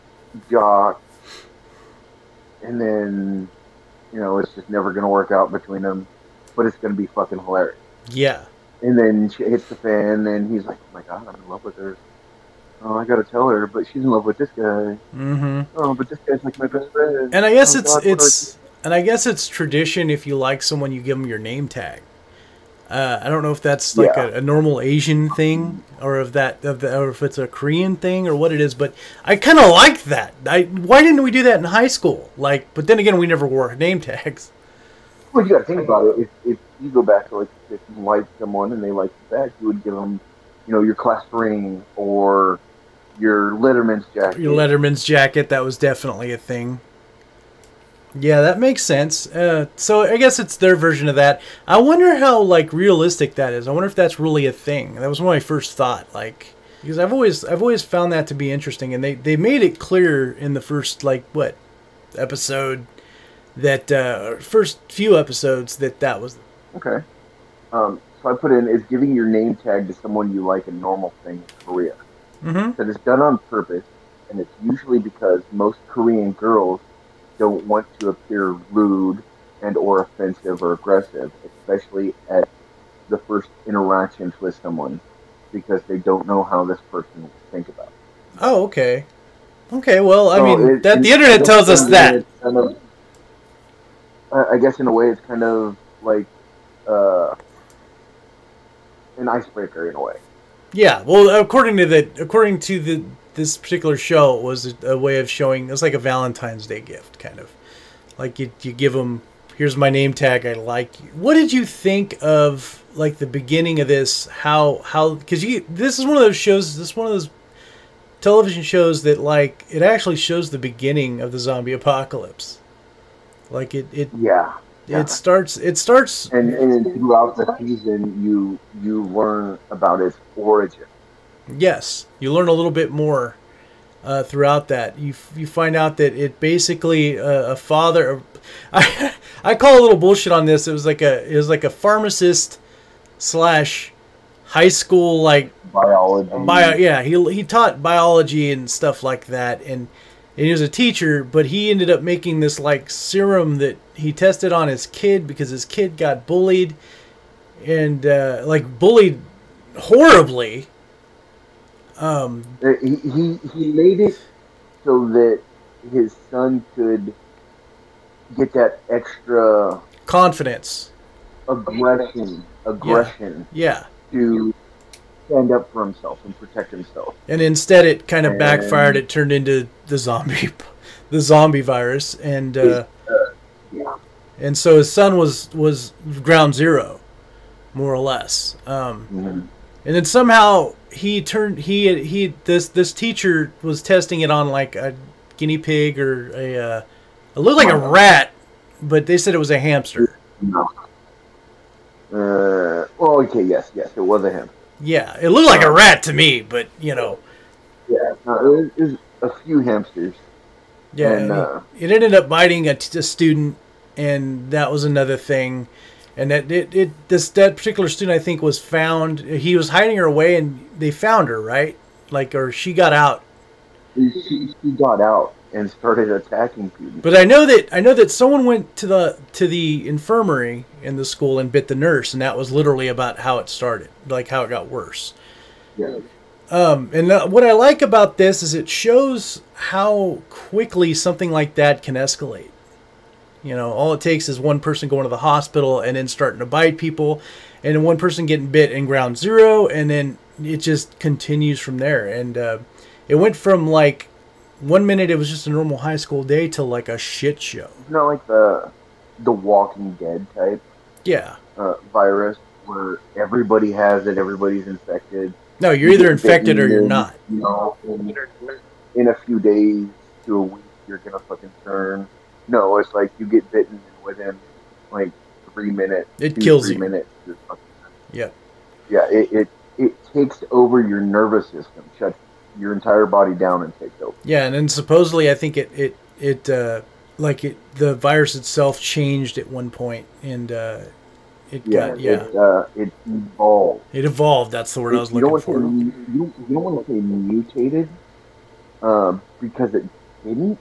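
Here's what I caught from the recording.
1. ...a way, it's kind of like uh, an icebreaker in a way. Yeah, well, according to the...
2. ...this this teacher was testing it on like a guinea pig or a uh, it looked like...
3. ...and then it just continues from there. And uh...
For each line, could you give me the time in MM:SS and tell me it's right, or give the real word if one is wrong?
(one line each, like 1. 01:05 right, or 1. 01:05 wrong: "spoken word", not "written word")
1. 01:34 right
2. 03:12 right
3. 04:09 right.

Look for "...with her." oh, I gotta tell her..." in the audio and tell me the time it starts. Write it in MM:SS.
00:11.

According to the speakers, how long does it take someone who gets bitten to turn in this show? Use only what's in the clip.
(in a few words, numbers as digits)
3 minutes.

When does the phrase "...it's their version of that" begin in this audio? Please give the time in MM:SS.
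00:50.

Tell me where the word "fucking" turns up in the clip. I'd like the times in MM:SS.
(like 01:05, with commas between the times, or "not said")
00:07, 04:31.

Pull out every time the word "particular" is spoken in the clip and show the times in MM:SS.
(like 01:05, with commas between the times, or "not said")
01:43, 03:37.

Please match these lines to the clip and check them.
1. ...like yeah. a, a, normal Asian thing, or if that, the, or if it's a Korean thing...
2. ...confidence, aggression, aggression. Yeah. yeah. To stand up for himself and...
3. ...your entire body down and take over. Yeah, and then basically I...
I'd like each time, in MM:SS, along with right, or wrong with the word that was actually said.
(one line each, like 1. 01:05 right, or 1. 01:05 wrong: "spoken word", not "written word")
1. 00:23 right
2. 02:50 right
3. 04:42 wrong: "supposedly", not "basically".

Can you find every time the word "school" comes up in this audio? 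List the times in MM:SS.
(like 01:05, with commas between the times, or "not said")
00:31, 02:24, 03:51, 04:15.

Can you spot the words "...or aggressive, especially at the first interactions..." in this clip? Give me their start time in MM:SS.
01:20.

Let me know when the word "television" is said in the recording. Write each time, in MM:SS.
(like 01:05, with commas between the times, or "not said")
01:58.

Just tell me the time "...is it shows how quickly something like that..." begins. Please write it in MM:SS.
03:58.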